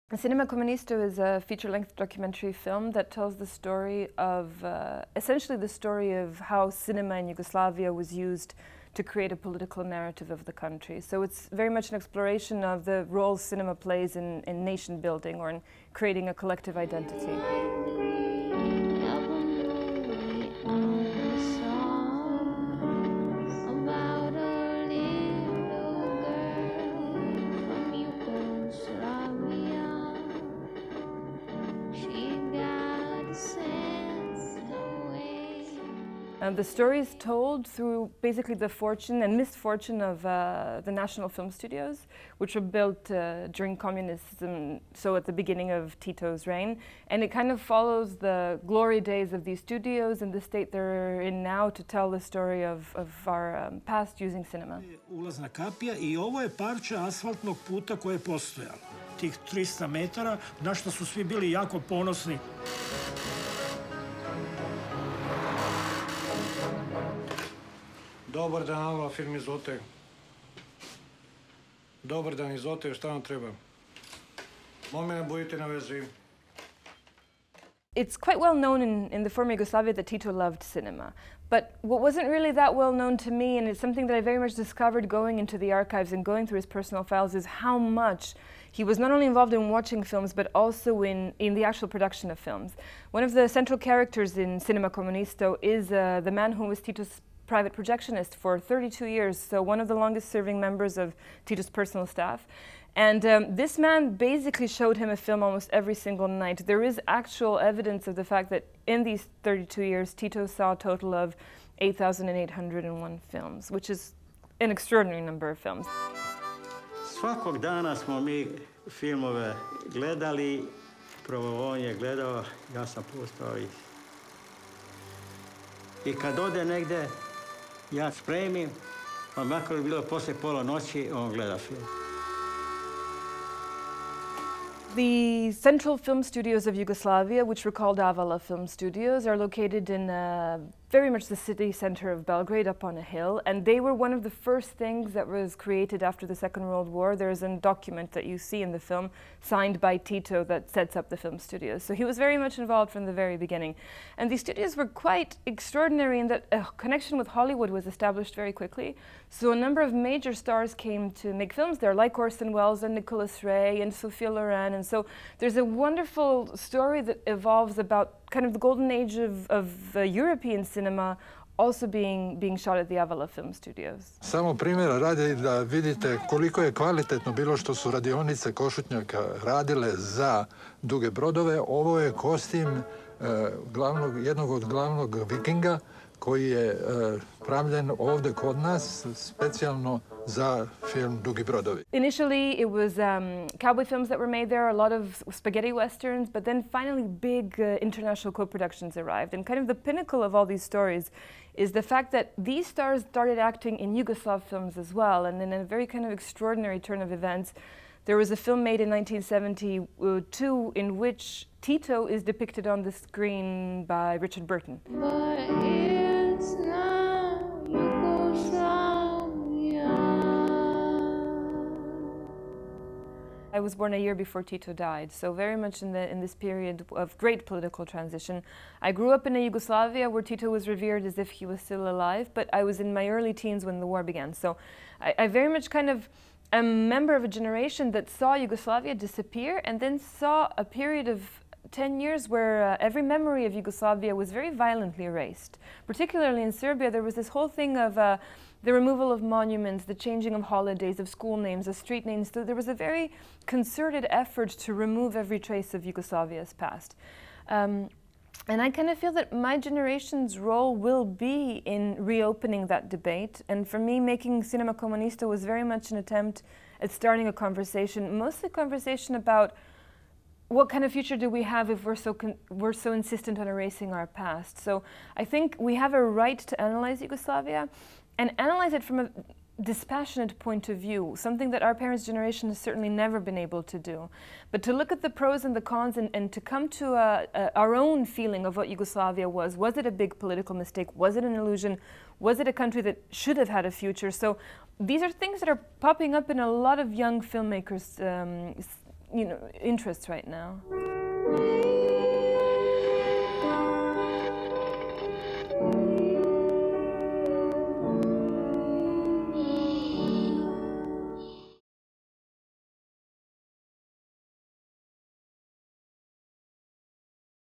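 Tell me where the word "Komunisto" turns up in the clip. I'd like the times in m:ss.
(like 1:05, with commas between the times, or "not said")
0:00, 1:34, 4:24.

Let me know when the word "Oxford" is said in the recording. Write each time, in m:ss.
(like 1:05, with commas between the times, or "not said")
not said.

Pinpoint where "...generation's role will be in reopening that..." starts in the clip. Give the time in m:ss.
4:19.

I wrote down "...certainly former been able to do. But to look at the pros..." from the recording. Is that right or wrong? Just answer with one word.
wrong.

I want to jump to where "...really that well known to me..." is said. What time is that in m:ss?
1:22.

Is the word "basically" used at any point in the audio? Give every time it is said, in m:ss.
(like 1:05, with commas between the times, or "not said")
0:38, 1:44.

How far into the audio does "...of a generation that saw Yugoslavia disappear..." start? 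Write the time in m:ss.
3:57.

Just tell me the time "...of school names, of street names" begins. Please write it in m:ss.
4:10.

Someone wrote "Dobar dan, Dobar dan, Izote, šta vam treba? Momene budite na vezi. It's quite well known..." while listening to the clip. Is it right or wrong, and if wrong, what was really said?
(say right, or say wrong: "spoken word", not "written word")
right.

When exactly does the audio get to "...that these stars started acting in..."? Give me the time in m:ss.
3:22.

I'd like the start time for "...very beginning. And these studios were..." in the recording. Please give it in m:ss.
2:33.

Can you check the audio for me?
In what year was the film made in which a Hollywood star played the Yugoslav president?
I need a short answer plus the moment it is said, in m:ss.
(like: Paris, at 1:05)
1972, at 3:28.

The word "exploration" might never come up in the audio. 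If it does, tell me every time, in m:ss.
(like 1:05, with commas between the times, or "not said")
0:11.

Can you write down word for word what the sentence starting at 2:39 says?
So a number of major stars came to make films there, like Orson Welles and Nicholas Ray and Sophia Loren.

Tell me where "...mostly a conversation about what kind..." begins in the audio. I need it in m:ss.
4:28.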